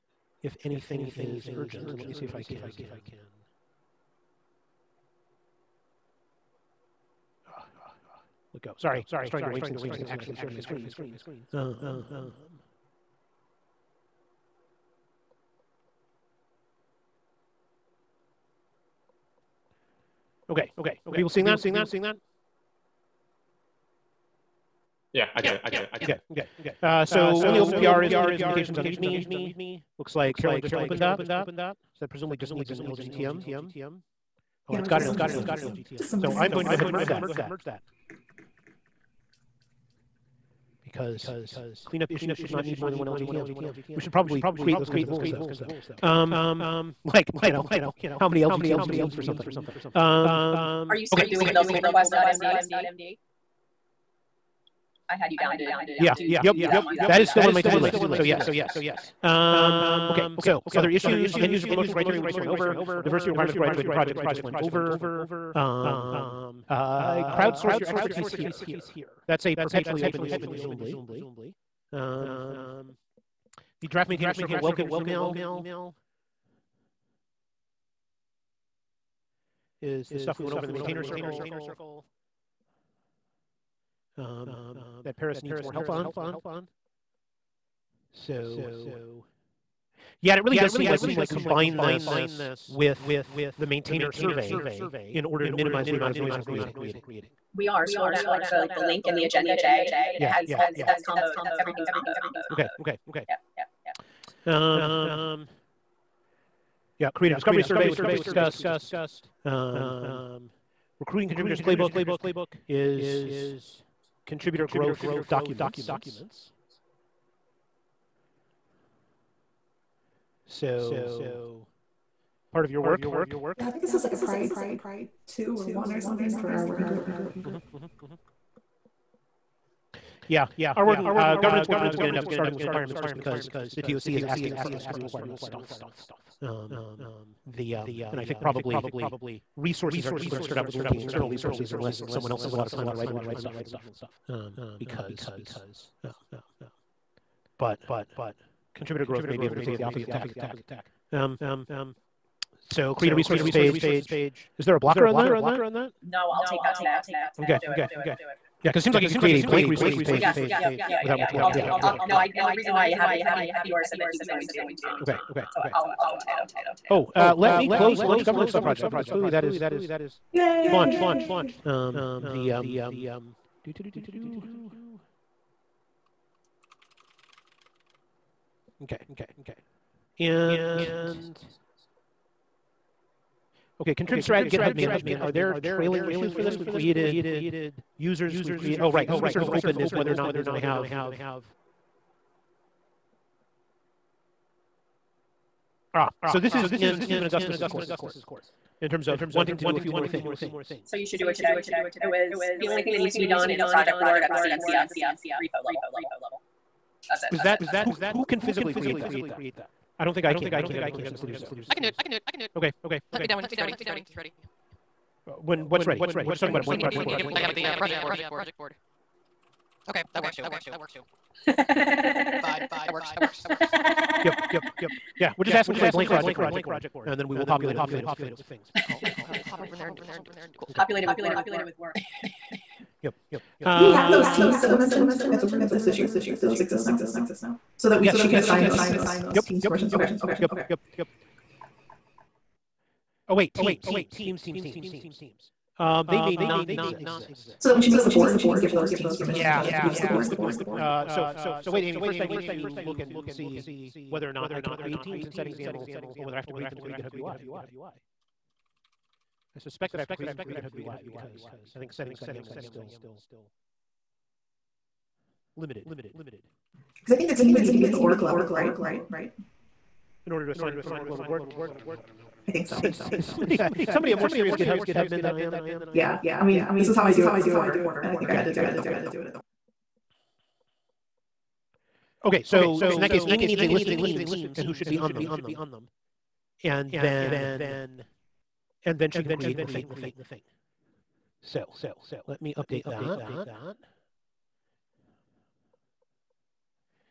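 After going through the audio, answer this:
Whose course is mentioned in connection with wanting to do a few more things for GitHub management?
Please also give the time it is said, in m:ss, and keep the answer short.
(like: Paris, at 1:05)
Stephen Augustus, at 3:16.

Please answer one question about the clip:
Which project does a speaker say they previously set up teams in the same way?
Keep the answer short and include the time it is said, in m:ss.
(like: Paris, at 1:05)
Porter, at 4:37.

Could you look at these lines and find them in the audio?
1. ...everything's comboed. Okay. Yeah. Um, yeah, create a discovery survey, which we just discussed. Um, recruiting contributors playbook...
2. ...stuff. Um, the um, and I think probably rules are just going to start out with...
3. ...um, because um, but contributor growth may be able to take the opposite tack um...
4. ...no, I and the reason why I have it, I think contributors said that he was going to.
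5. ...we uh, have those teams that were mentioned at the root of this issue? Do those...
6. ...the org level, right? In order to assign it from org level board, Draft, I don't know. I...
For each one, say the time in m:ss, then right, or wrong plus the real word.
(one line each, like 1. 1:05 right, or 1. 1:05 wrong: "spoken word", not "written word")
1. 1:41 right
2. 2:15 wrong: "resources", not "rules"
3. 2:24 right
4. 2:42 wrong: "yours", not "contributors"
5. 3:53 right
6. 4:27 wrong: "Jesus", not "Draft".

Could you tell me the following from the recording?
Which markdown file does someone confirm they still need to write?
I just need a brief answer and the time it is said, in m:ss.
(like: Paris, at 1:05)
pull request.md, at 0:51.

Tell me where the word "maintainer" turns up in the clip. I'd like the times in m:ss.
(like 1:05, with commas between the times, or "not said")
1:14, 1:20, 1:33.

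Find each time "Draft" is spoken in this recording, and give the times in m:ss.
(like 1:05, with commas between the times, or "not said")
1:13.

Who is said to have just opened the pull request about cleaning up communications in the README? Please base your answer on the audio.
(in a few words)
Carolyn.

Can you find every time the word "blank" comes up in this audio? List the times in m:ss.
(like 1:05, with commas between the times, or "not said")
2:39, 3:36, 3:45.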